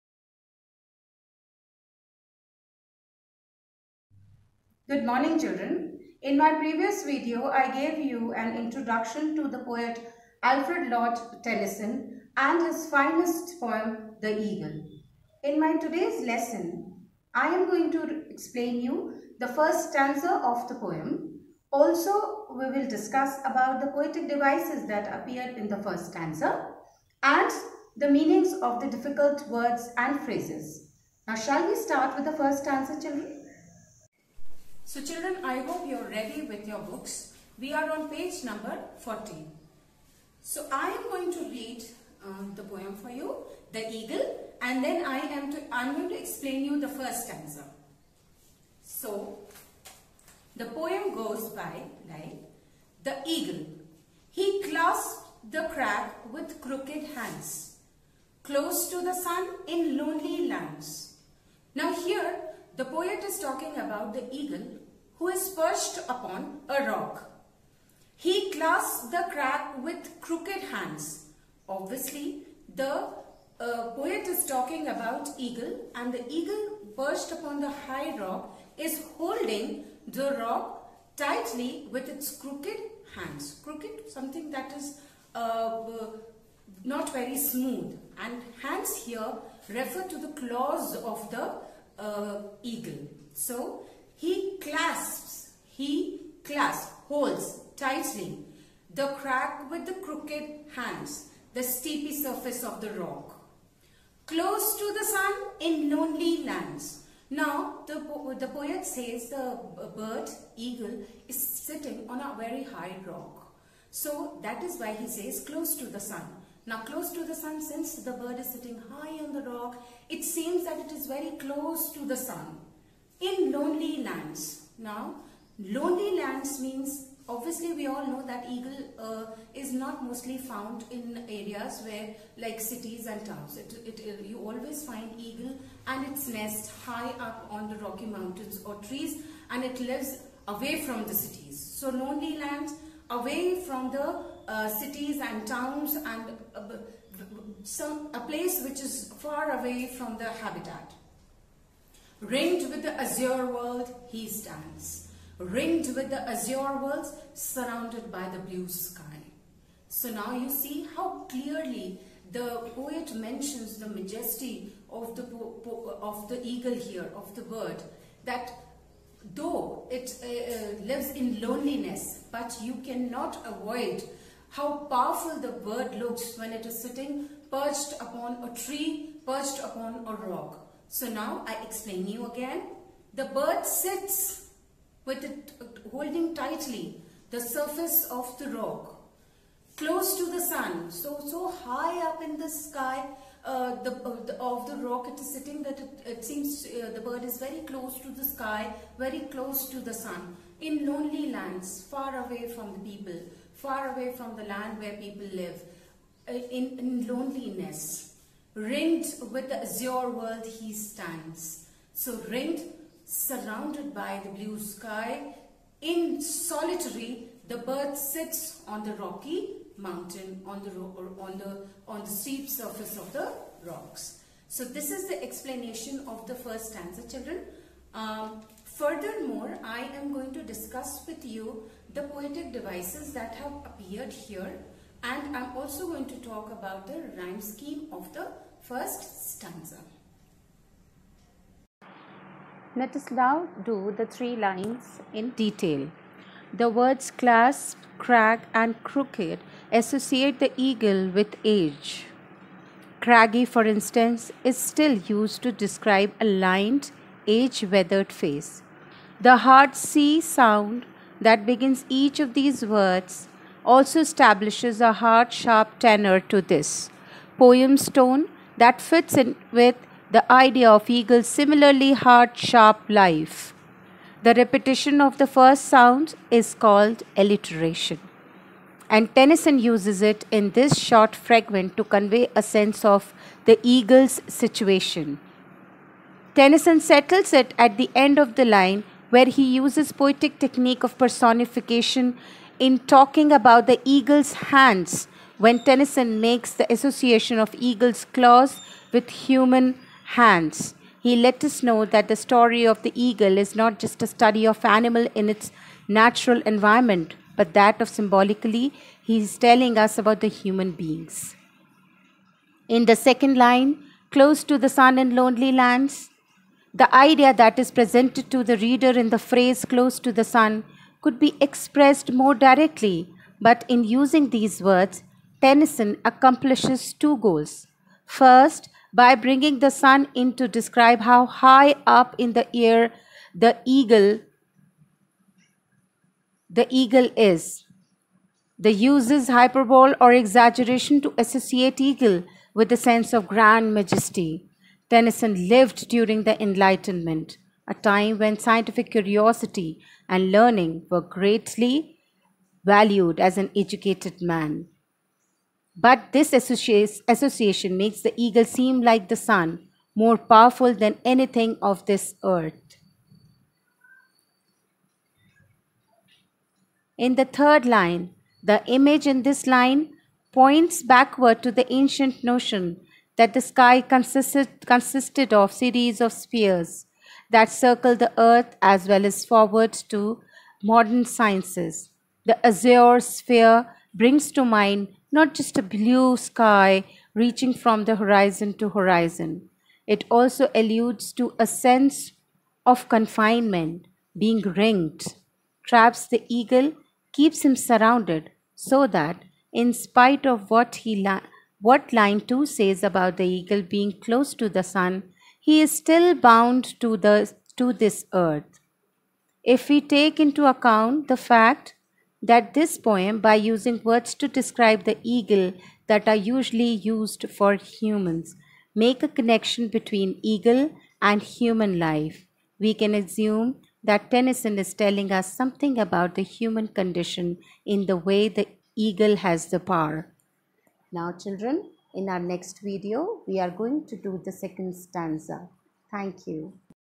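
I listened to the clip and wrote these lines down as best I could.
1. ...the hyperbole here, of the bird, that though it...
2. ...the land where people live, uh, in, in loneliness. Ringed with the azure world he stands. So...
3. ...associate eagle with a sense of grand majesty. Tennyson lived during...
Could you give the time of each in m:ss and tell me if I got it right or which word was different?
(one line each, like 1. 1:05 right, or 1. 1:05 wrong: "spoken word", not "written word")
1. 2:46 wrong: "eagle", not "hyperbole"
2. 3:24 right
3. 5:41 right.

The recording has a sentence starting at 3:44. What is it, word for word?
So this is the explanation of the first stanza, children.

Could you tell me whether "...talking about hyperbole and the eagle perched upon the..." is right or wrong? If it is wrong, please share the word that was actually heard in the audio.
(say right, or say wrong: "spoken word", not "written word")
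wrong: "eagle", not "hyperbole".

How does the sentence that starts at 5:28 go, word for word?
First, by bringing the sun in to describe how high up in the air the eagle the eagle is.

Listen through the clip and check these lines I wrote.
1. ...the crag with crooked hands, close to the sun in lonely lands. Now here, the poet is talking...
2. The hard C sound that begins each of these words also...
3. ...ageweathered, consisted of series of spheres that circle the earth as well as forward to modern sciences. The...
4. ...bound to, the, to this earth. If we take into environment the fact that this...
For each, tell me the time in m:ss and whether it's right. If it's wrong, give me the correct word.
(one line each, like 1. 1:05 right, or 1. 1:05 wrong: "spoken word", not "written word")
1. 0:55 right
2. 4:19 right
3. 6:13 wrong: "consisted", not "ageweathered"
4. 6:46 wrong: "account", not "environment".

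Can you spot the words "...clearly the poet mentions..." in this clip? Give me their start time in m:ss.
2:41.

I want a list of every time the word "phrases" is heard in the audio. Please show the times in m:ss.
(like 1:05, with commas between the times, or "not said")
0:30, 5:19.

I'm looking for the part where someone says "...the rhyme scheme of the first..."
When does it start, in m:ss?
3:56.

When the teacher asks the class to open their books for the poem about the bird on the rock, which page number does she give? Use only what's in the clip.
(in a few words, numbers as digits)
14.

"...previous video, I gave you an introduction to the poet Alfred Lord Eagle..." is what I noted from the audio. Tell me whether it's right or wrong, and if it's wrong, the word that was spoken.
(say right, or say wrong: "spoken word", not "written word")
wrong: "Tennyson", not "Eagle".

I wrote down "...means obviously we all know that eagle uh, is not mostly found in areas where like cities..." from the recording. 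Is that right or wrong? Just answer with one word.
right.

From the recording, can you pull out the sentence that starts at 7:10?
Now, children, in our next video, we are going to do the second stanza.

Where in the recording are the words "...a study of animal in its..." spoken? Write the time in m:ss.
5:04.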